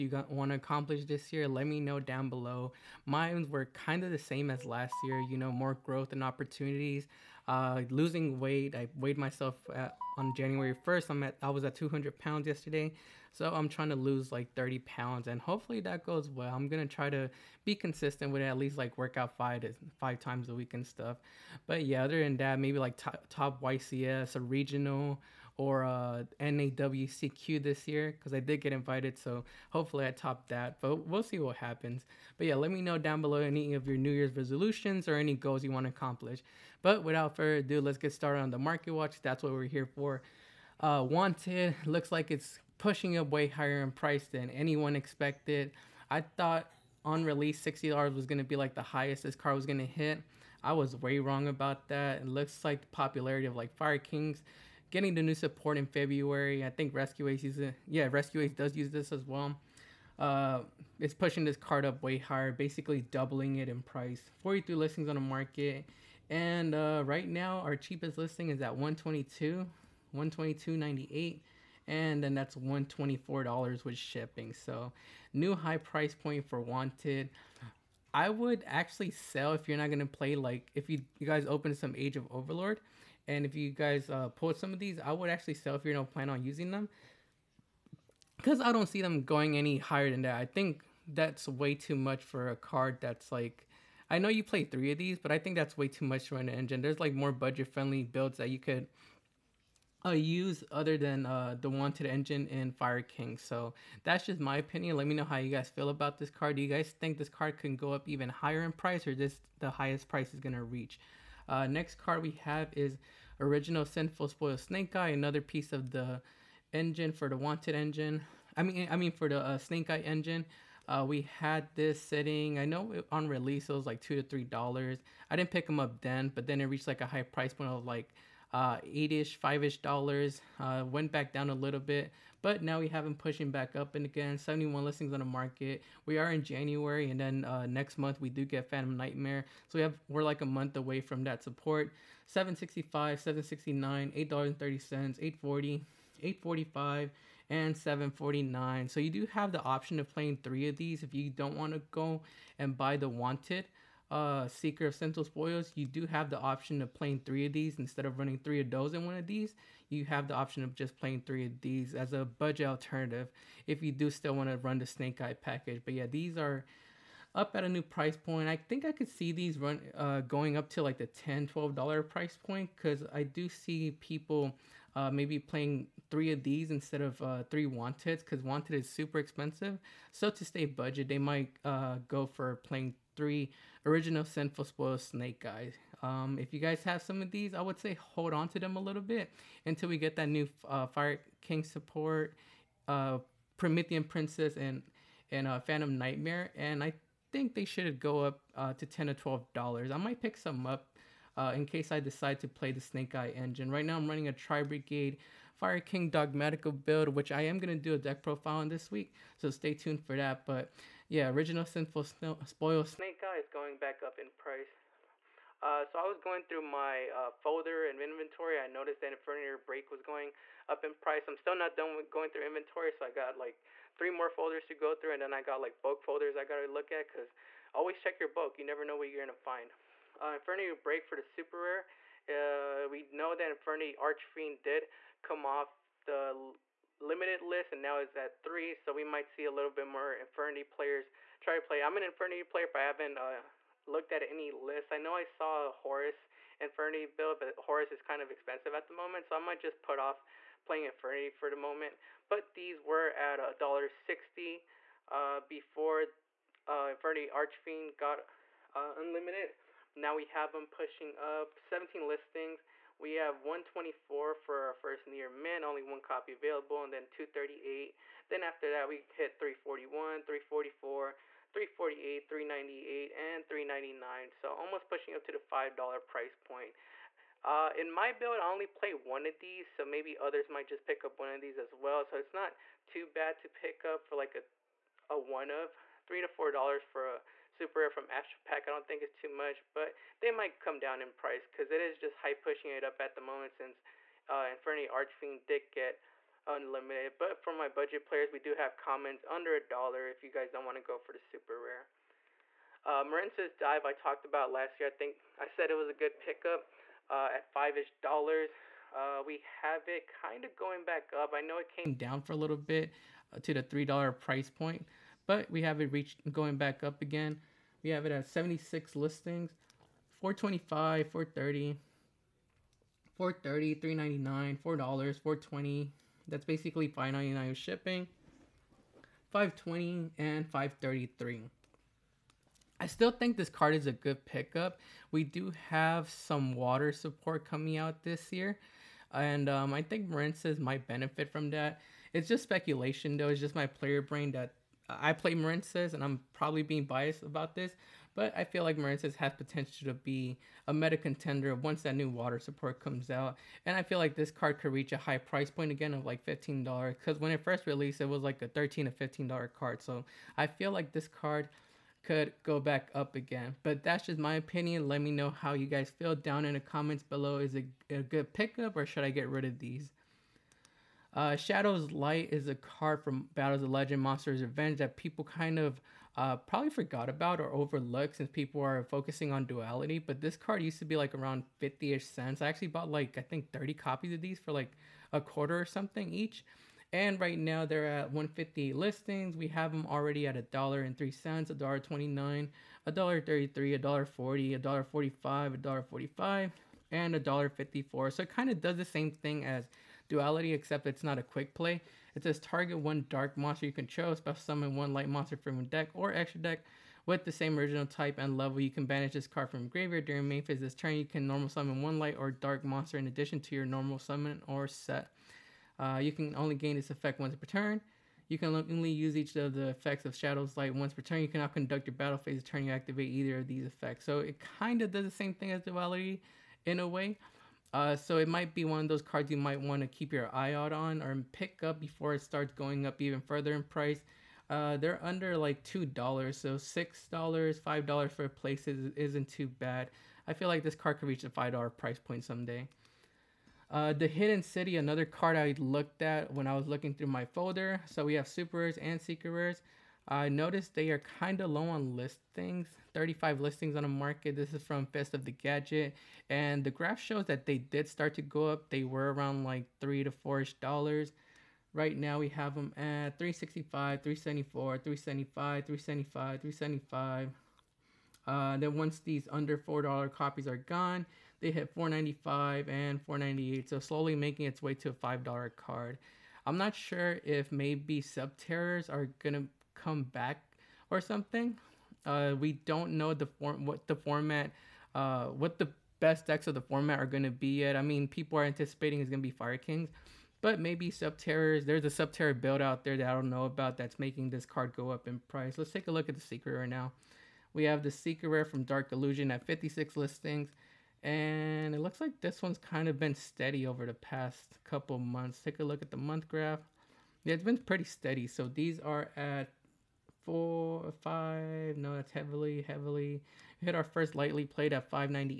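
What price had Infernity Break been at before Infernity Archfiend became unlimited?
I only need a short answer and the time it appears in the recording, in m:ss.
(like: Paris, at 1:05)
$1.60, at 4:13.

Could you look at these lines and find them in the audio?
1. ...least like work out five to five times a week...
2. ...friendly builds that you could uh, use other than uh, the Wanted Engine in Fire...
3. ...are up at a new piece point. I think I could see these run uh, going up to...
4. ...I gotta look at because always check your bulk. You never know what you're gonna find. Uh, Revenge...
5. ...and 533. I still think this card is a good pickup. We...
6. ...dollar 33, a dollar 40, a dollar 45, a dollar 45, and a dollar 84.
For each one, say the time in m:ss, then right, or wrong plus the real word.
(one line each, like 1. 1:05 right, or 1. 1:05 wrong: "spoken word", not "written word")
1. 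0:18 right
2. 1:37 right
3. 2:46 wrong: "price", not "piece"
4. 3:46 wrong: "Break", not "Revenge"
5. 5:30 right
6. 6:32 wrong: "54", not "84".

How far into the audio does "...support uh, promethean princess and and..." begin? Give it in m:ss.
3:11.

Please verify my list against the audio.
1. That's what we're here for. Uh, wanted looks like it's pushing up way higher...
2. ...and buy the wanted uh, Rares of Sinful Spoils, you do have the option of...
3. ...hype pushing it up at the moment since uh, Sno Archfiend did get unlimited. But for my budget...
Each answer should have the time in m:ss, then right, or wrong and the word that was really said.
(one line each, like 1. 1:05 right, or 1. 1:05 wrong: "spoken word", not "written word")
1. 0:39 right
2. 2:32 wrong: "Seeker", not "Rares"
3. 4:52 wrong: "Infernity", not "Sno".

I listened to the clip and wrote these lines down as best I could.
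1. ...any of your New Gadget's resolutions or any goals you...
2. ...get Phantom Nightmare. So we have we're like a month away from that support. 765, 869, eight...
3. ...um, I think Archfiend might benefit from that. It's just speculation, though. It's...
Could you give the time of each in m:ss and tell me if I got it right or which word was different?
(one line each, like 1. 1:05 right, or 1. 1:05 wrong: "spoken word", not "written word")
1. 0:33 wrong: "Year", not "Gadget"
2. 2:18 wrong: "769", not "869"
3. 5:39 wrong: "Marincess", not "Archfiend".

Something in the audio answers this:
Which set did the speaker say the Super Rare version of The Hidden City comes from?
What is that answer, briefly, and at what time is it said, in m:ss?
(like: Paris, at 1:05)
Fists of the Gadget, at 7:34.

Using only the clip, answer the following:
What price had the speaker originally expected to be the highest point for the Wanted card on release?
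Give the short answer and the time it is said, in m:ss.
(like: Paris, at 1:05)
$60, at 0:47.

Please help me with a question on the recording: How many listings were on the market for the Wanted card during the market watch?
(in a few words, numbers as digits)
43.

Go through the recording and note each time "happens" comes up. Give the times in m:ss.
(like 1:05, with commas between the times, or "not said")
0:31.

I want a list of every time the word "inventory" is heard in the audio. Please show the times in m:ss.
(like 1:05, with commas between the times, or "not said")
3:37, 3:42.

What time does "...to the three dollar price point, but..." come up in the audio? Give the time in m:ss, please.
5:13.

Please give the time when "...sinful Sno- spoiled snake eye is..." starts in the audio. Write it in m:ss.
3:31.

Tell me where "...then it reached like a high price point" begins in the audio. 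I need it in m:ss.
2:06.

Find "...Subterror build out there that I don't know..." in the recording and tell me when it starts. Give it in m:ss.
8:12.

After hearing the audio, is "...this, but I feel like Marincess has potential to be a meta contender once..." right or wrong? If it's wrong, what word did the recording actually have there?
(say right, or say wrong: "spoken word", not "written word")
right.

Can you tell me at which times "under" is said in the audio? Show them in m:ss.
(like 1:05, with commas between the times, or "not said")
4:59, 7:15, 7:49.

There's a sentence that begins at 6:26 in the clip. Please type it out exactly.
And right now they're at 150 listings.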